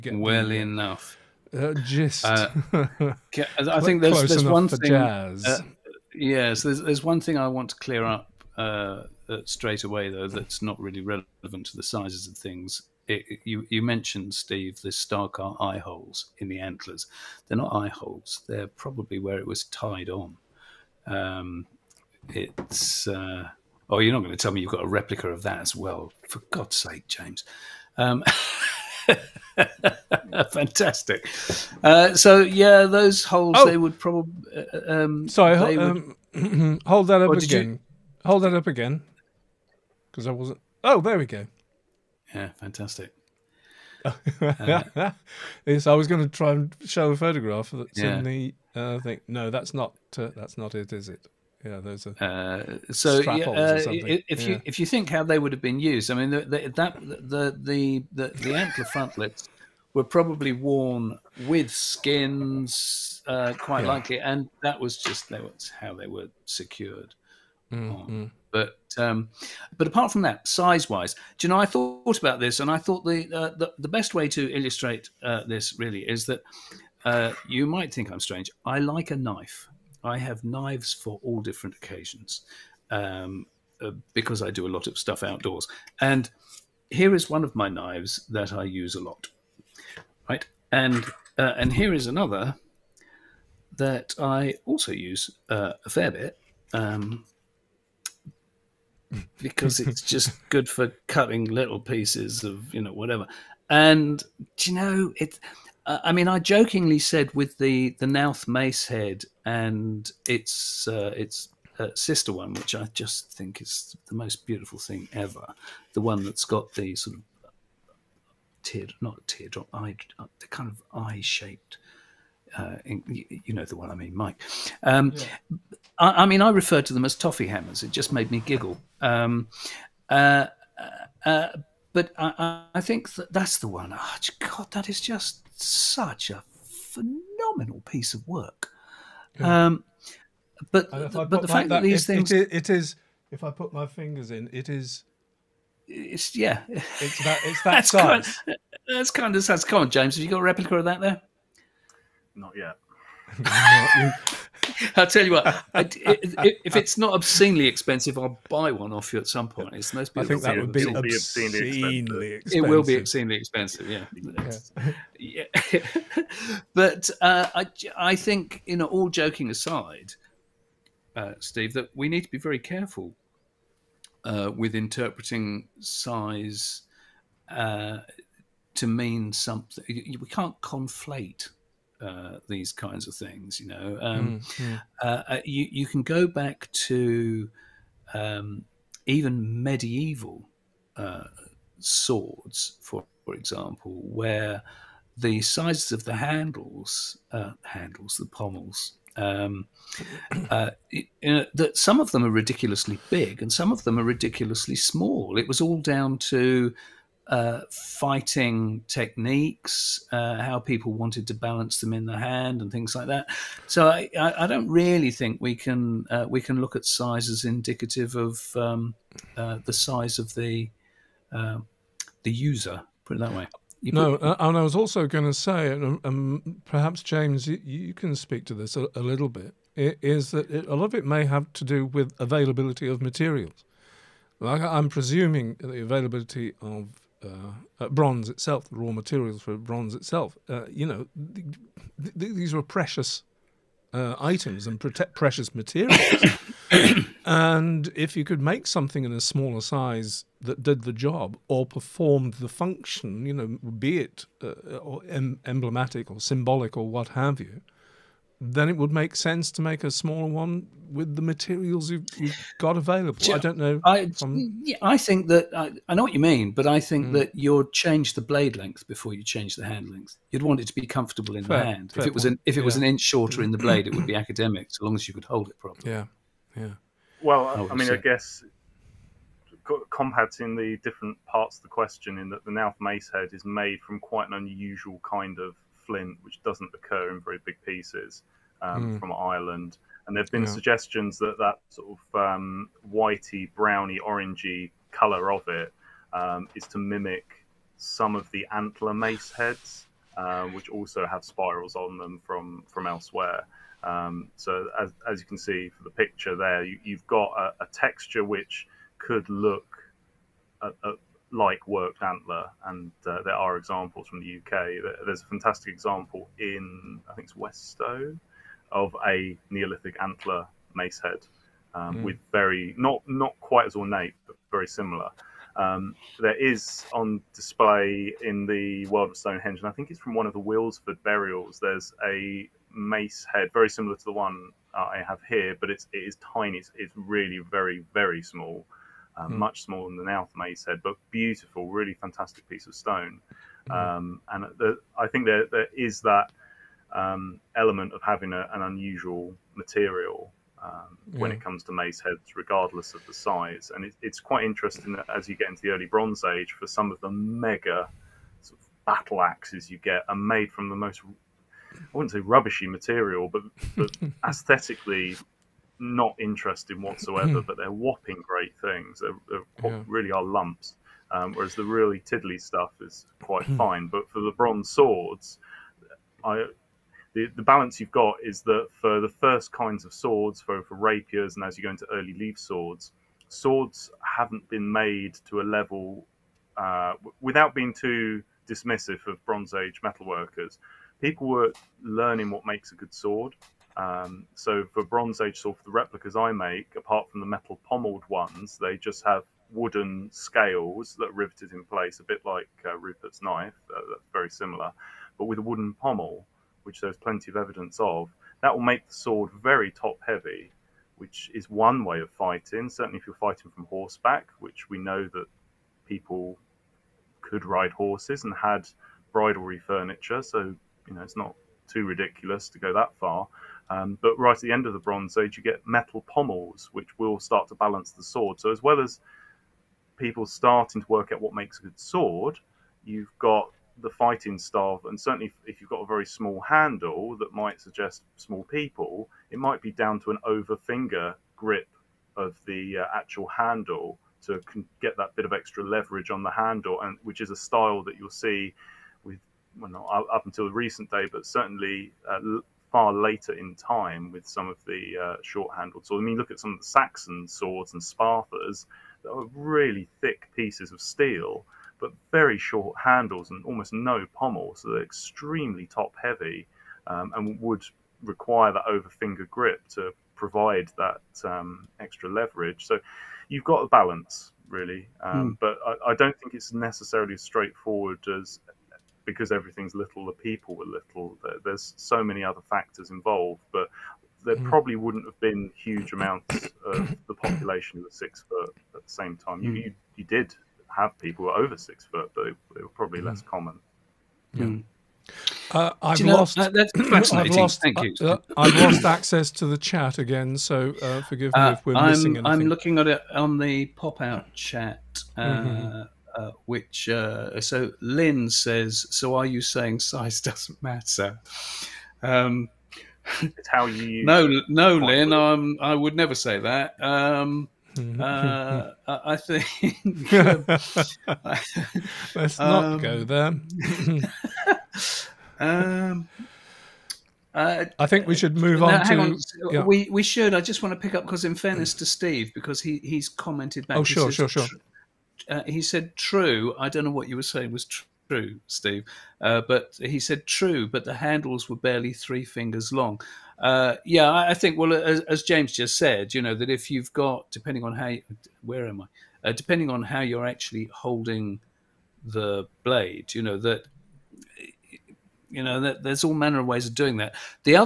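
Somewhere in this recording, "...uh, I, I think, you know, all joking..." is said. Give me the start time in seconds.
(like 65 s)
167 s.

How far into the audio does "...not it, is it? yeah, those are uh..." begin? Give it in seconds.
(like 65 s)
50 s.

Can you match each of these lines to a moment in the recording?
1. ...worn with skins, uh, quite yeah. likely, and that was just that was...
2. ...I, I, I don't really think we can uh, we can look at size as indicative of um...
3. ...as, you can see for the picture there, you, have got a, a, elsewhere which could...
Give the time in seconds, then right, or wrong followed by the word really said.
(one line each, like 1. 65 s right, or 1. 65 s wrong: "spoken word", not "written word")
1. 60 s right
2. 213 s right
3. 305 s wrong: "texture", not "elsewhere".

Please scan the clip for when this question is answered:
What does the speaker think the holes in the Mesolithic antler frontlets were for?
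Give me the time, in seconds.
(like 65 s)
19 s.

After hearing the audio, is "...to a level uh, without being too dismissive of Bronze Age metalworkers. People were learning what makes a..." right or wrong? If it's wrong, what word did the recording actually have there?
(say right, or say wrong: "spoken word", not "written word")
right.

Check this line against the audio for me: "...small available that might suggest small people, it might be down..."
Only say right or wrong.
wrong.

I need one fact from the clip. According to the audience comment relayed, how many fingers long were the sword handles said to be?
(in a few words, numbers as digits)
3.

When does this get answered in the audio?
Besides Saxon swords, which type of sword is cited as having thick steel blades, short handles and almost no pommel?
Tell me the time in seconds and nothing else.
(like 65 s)
457 s.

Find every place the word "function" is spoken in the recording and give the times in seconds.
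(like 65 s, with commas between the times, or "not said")
252 s.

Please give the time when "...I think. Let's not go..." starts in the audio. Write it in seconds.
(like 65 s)
518 s.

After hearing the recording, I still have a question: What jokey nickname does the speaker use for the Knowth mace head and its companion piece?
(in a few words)
Toffee hammers.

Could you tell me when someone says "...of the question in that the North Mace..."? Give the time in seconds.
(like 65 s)
281 s.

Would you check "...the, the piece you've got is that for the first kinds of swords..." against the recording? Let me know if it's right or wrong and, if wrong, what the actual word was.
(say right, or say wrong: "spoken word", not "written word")
wrong: "balance", not "piece".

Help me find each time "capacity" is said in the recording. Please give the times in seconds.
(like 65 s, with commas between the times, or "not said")
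not said.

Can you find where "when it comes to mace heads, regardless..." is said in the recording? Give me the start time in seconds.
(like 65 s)
351 s.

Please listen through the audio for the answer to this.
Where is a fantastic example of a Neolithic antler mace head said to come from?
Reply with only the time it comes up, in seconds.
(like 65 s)
317 s.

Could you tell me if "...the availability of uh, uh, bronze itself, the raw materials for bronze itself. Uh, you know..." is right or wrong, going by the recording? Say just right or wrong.
right.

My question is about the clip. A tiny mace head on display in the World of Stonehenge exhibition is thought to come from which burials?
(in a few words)
Wilsford burials.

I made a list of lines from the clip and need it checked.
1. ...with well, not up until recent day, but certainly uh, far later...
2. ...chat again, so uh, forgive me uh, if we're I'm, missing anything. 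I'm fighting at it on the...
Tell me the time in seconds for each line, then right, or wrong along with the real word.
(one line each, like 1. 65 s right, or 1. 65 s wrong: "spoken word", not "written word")
1. 449 s right
2. 499 s wrong: "looking", not "fighting".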